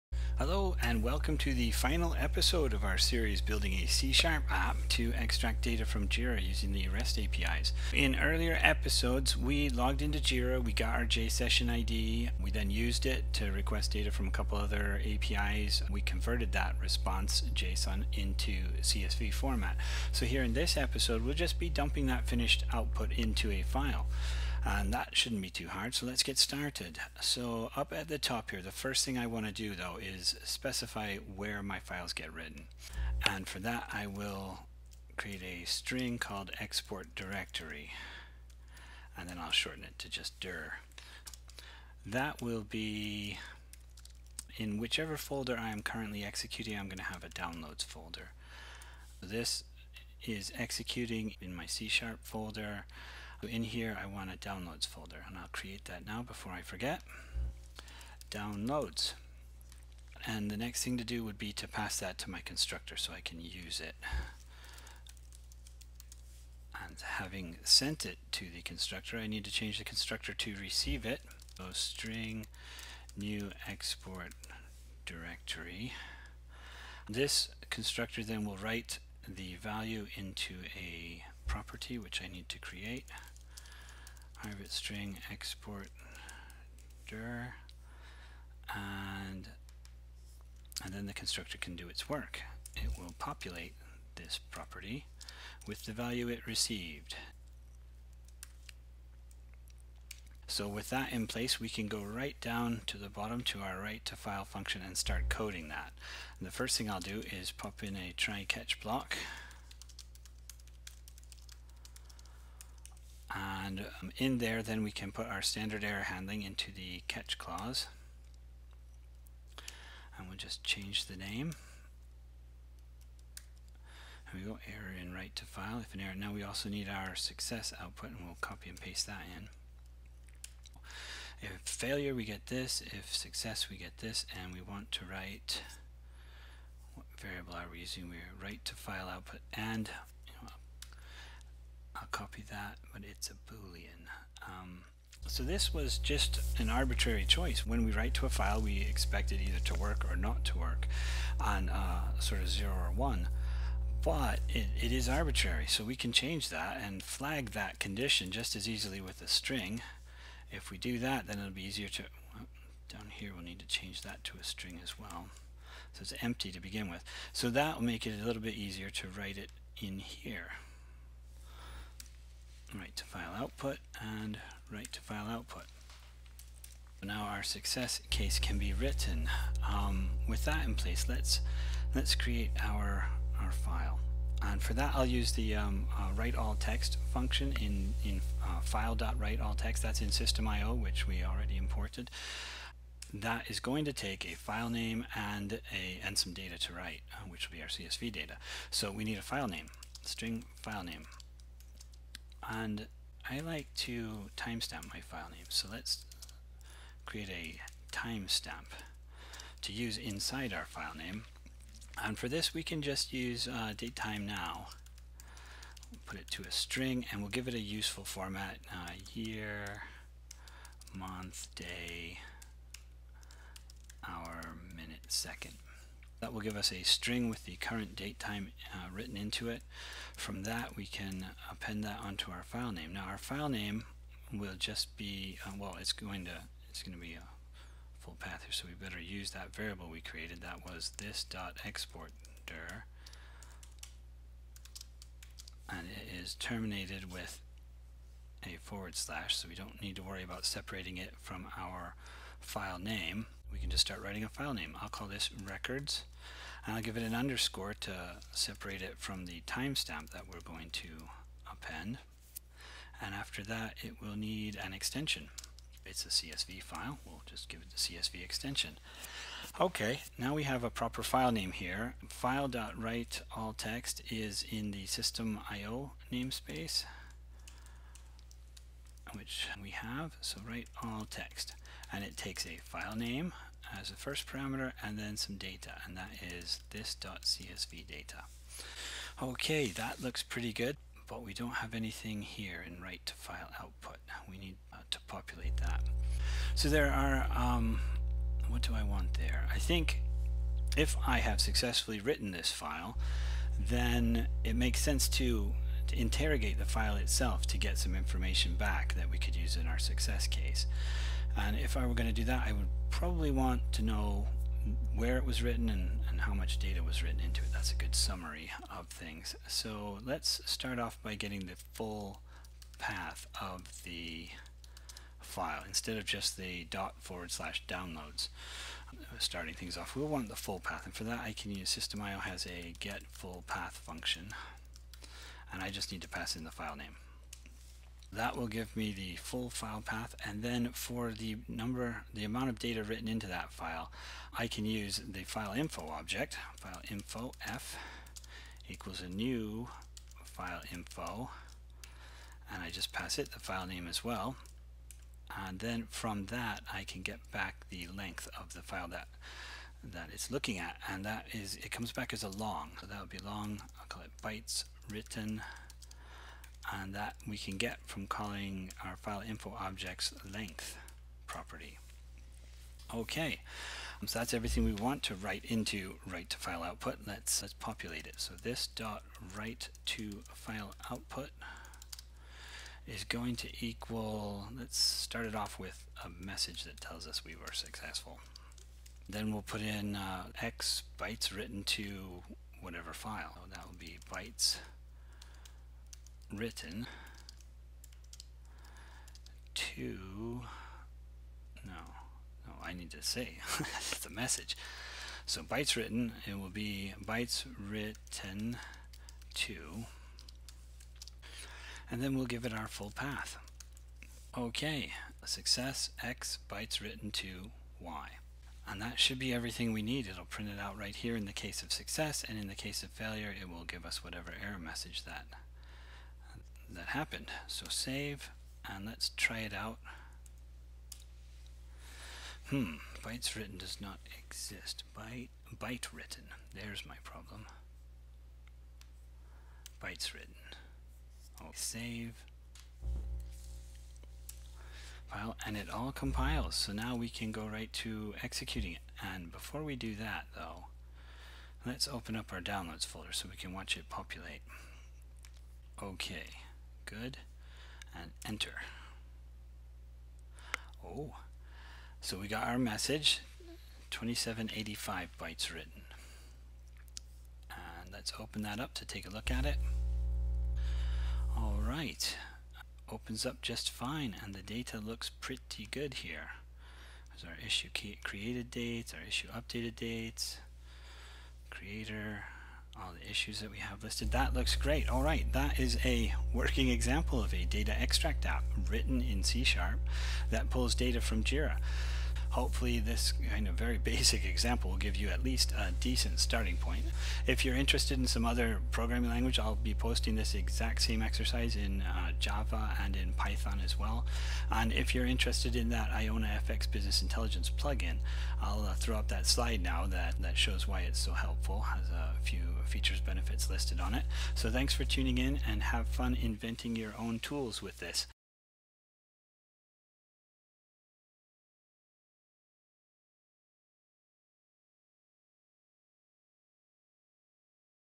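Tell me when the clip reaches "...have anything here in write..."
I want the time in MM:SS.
04:51.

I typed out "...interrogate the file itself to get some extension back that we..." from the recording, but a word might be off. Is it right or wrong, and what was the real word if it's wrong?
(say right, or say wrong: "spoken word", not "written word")
wrong: "information", not "extension".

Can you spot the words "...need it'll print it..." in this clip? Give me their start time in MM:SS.
06:59.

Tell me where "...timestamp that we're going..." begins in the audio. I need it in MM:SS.
04:19.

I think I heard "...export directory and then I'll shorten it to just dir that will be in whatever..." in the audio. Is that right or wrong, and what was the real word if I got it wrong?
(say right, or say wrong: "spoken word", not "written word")
wrong: "whichever", not "whatever".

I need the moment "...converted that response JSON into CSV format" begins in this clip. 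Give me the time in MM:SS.
00:16.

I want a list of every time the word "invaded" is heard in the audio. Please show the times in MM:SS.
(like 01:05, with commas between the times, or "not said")
not said.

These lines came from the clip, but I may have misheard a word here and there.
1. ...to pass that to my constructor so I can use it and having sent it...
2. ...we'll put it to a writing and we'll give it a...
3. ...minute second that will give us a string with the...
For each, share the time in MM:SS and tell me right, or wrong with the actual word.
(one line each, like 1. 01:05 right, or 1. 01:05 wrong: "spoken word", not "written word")
1. 01:01 right
2. 03:35 wrong: "string", not "writing"
3. 03:44 right.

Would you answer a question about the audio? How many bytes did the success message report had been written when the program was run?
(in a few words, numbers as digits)
2785.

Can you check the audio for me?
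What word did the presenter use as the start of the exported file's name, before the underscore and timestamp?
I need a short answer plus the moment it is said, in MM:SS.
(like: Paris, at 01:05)
records, at 04:15.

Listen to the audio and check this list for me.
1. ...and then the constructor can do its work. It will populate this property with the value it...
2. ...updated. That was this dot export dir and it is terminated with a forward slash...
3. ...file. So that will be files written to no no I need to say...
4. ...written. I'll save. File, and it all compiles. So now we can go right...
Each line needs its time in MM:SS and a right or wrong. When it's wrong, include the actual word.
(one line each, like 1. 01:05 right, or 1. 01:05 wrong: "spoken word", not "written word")
1. 01:30 right
2. 03:59 wrong: "created", not "updated"
3. 06:32 wrong: "bytes", not "files"
4. 07:20 right.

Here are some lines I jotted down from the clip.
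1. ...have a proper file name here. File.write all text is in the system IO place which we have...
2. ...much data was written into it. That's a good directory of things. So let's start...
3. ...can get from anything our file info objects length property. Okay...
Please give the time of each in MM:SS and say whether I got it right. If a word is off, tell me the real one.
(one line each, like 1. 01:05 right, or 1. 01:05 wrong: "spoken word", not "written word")
1. 04:30 wrong: "namespace", not "place"
2. 05:16 wrong: "summary", not "directory"
3. 06:07 wrong: "calling", not "anything".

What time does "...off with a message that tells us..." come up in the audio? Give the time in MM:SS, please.
06:25.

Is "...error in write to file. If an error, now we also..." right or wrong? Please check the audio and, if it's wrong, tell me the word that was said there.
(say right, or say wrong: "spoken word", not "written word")
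right.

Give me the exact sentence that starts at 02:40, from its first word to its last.
If we do that, then it'll be easier to...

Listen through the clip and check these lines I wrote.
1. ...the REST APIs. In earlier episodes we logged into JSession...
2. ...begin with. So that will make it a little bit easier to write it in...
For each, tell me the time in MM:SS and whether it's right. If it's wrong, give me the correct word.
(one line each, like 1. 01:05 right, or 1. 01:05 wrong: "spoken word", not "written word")
1. 00:06 wrong: "Jira", not "JSession"
2. 02:46 right.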